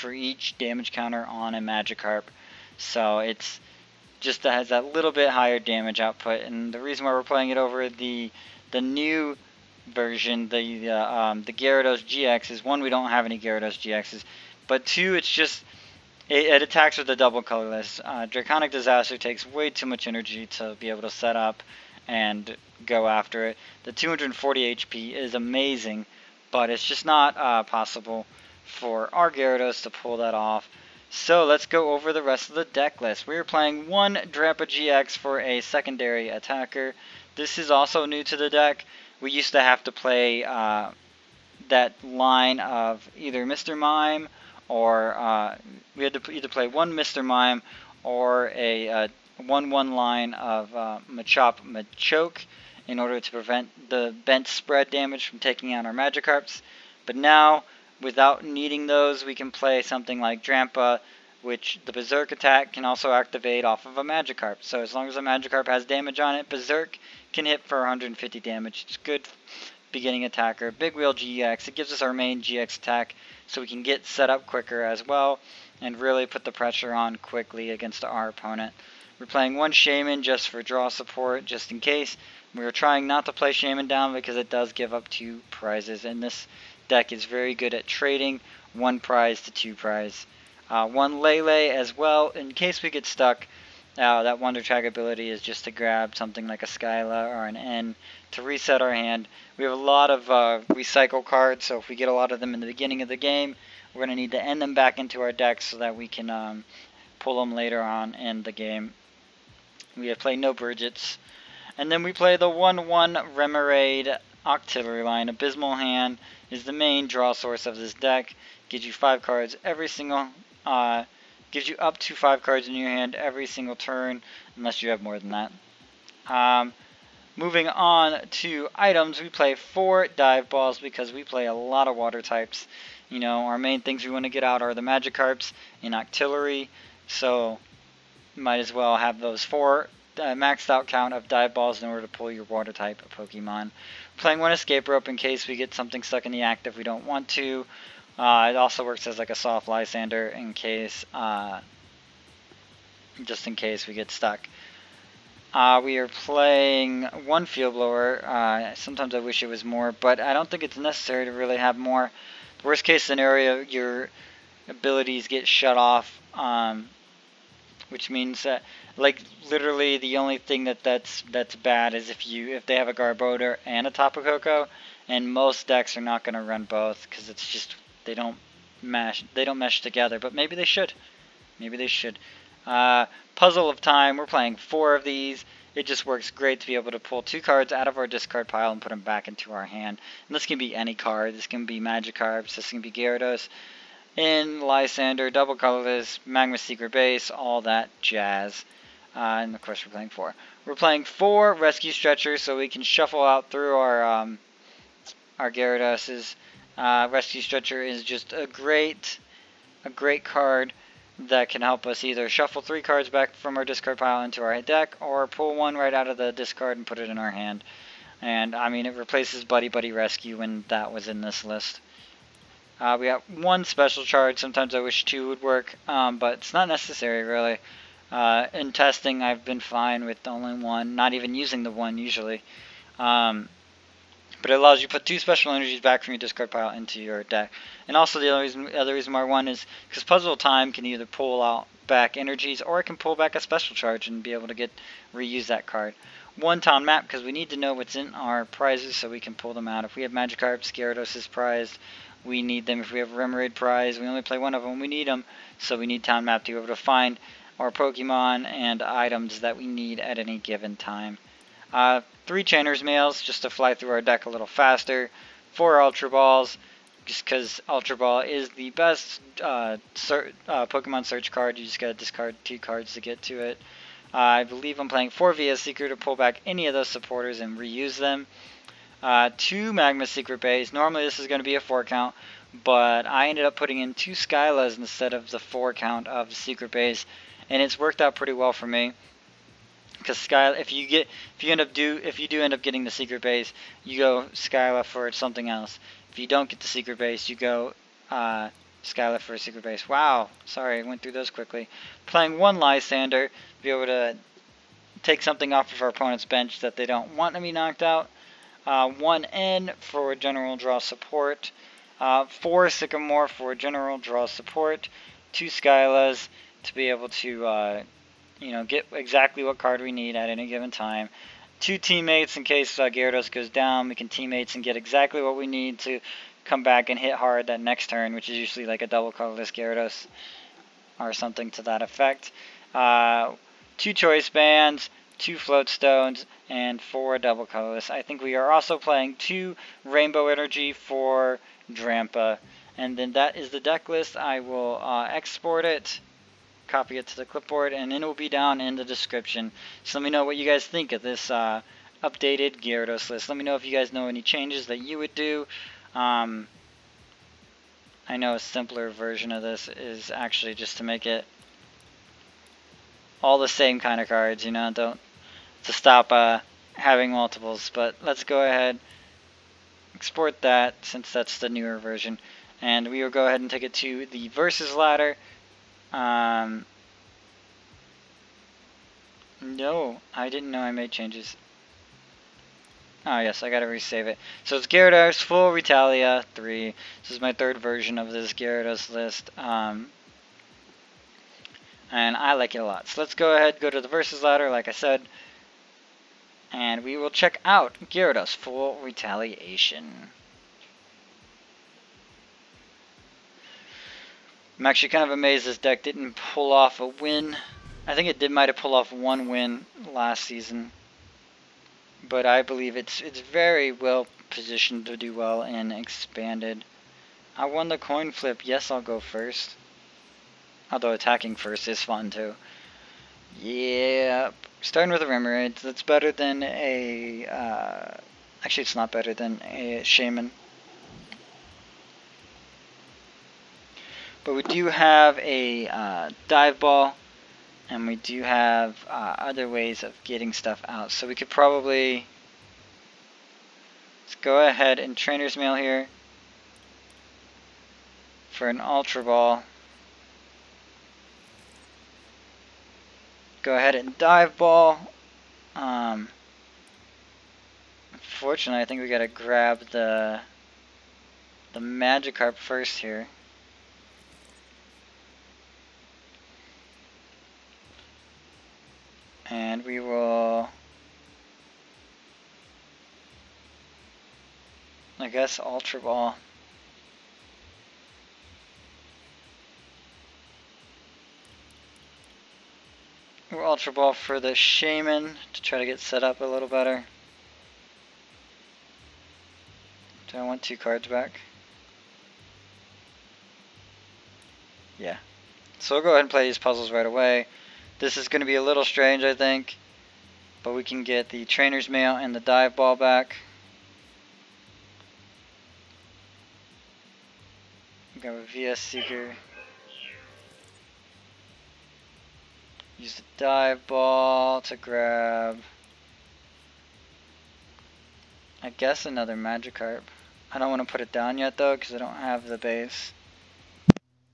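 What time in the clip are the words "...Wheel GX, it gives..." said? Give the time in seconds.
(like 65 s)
70 s.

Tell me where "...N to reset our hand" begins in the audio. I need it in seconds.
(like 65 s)
97 s.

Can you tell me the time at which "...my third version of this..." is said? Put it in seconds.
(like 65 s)
387 s.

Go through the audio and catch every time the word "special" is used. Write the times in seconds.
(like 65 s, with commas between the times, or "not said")
223 s, 235 s, 243 s.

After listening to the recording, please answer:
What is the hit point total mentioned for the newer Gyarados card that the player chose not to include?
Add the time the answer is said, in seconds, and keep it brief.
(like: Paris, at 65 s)
240, at 23 s.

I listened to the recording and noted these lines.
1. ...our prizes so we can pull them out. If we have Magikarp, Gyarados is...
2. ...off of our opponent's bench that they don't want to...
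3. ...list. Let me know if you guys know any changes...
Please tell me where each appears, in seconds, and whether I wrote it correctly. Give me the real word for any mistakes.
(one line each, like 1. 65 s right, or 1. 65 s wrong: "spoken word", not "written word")
1. 248 s right
2. 305 s right
3. 353 s right.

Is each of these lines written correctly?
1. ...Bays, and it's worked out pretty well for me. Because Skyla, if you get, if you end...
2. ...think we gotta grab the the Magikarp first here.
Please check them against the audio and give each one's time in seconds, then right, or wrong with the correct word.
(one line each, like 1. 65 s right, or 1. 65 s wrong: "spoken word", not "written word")
1. 286 s right
2. 458 s right.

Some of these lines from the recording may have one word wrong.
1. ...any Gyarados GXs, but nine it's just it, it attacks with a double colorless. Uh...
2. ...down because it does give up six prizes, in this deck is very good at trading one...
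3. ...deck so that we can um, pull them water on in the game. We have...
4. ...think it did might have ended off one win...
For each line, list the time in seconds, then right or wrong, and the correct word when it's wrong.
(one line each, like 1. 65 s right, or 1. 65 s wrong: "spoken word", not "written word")
1. 13 s wrong: "two", not "nine"
2. 83 s wrong: "two", not "six"
3. 105 s wrong: "later", not "water"
4. 407 s wrong: "pulled", not "ended".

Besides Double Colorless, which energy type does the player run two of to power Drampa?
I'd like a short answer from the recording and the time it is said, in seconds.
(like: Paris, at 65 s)
Rainbow Energy, at 339 s.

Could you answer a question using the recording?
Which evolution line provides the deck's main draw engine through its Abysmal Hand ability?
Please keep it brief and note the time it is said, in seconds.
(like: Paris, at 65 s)
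Remoraid Octillery, at 113 s.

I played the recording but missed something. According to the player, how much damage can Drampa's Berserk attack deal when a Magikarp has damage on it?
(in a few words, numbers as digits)
150.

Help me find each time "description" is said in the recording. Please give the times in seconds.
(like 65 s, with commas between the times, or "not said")
348 s.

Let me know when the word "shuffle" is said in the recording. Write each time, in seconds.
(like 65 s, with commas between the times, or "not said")
202 s, 212 s.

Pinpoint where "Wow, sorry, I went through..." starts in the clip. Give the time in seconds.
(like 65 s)
299 s.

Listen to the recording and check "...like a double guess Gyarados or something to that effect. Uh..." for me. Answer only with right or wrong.
wrong.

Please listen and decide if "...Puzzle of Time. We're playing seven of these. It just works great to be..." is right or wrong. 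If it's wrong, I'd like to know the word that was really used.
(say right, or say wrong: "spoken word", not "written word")
wrong: "four", not "seven".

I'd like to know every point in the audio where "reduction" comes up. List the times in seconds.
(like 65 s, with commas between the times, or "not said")
not said.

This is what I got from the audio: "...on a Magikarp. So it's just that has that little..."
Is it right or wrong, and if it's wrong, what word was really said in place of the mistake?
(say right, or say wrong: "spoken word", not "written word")
right.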